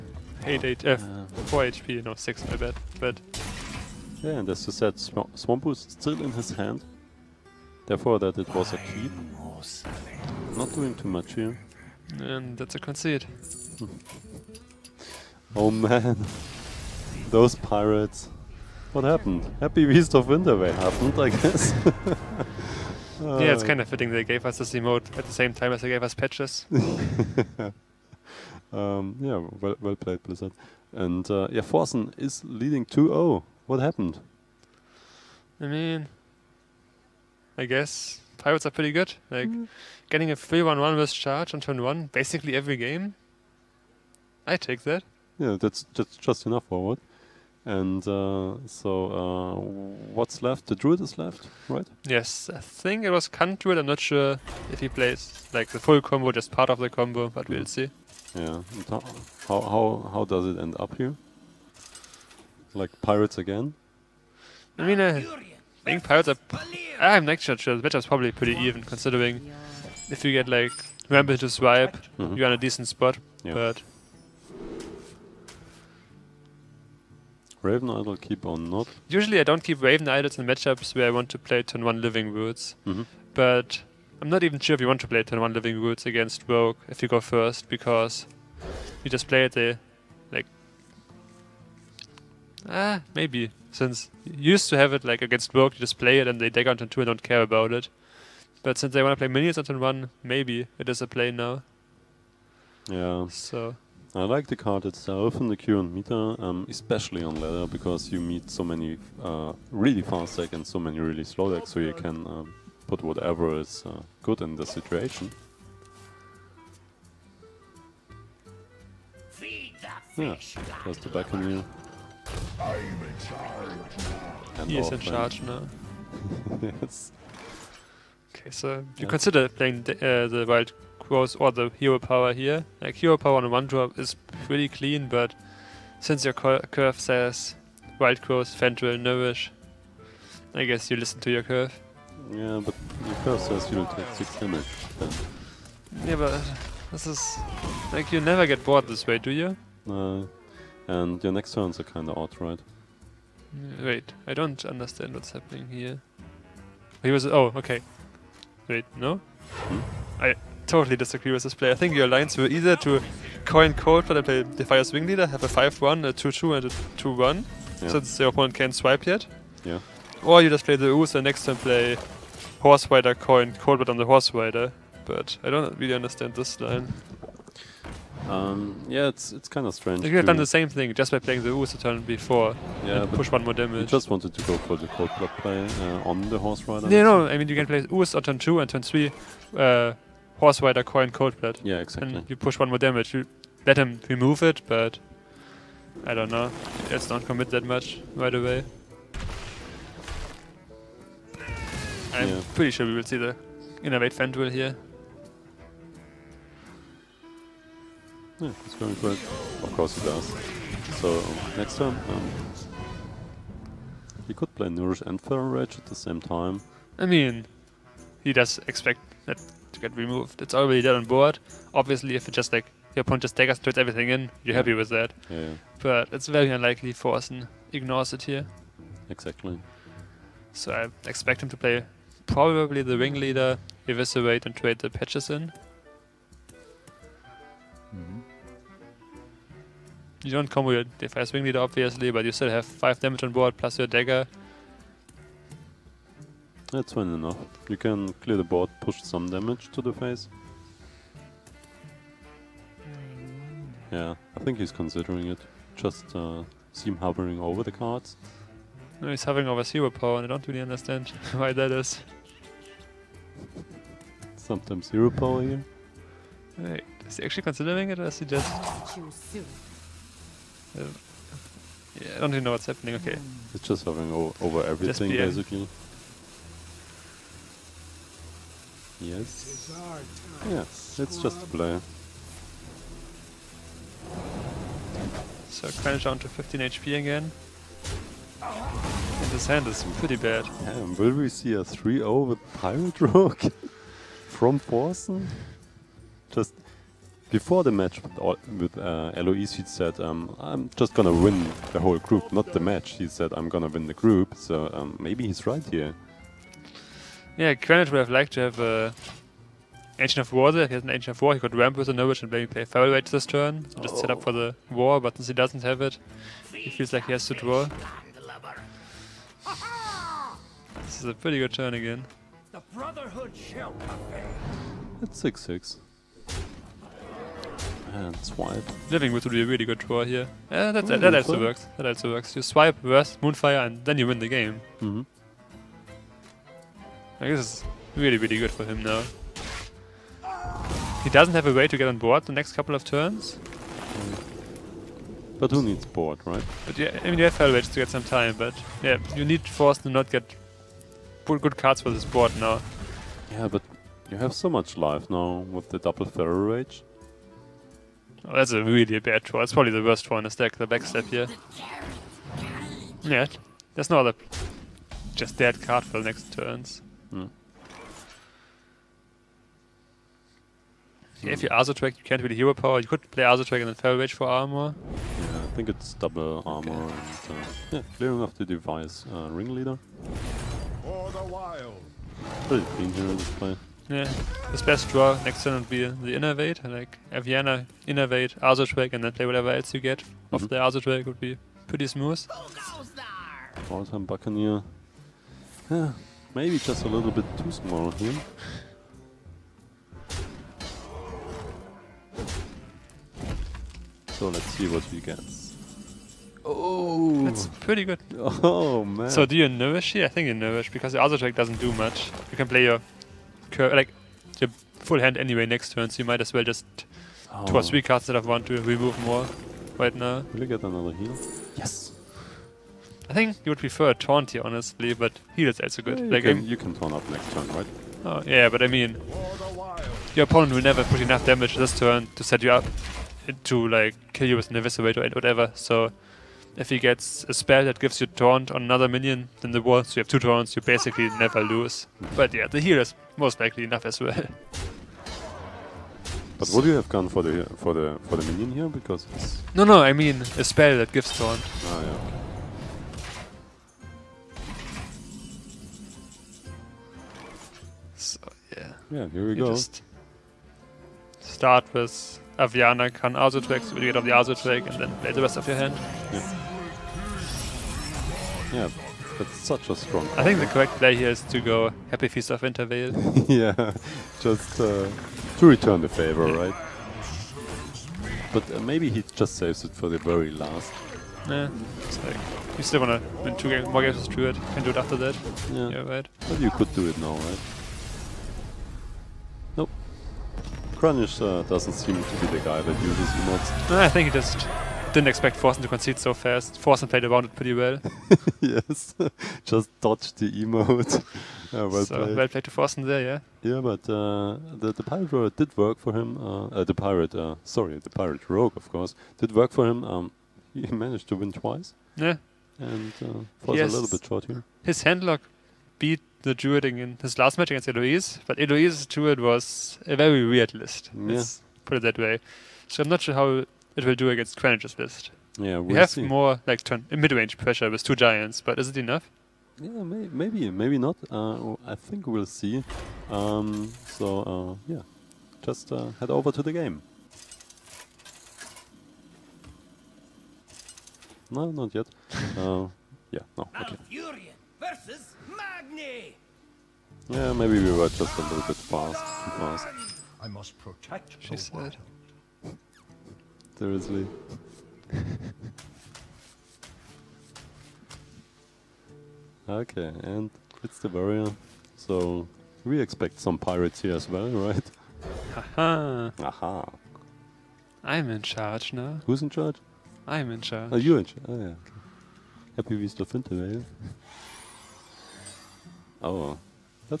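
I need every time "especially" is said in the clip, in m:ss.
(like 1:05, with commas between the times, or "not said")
1:46.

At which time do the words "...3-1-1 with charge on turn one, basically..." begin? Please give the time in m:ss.
0:40.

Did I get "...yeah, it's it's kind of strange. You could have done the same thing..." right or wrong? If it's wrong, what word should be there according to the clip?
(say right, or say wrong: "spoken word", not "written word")
right.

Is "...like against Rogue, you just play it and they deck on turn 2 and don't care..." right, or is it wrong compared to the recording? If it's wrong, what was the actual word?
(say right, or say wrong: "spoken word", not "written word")
right.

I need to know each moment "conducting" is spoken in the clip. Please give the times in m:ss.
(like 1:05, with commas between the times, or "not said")
not said.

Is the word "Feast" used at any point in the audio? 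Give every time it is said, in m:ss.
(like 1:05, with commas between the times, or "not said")
7:52.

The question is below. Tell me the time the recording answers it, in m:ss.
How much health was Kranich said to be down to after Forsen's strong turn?
4:46.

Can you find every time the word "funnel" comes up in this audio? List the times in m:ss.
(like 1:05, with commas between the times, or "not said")
not said.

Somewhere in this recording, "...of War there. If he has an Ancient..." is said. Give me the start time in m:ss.
5:10.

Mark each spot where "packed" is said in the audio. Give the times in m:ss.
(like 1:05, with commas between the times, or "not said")
not said.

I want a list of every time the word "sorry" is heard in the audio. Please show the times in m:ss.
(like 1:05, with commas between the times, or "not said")
8:27.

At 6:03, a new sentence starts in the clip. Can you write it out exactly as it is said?
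Yeah, there's no other just dead card for the next turns.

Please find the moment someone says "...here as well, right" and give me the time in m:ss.
9:23.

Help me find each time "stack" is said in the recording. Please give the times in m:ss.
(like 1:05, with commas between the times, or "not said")
6:00.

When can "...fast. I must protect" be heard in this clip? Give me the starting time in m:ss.
9:09.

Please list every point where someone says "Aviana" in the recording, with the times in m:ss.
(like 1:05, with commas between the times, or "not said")
6:27, 7:42.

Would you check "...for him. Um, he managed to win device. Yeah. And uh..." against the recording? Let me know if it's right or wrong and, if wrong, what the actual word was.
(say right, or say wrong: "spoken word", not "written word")
wrong: "twice", not "device".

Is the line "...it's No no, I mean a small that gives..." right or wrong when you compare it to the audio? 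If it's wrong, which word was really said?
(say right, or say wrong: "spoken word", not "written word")
wrong: "spell", not "small".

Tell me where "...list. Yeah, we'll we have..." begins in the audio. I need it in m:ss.
8:44.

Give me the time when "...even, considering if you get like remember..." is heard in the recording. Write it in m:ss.
1:08.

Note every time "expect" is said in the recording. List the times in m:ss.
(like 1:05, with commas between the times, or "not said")
3:38, 3:51, 8:15, 9:22.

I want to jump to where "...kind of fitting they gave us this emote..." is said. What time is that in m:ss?
0:23.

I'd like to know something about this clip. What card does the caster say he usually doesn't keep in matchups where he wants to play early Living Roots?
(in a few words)
Raven Idol.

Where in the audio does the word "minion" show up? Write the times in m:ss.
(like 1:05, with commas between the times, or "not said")
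1:39, 7:18, 7:28.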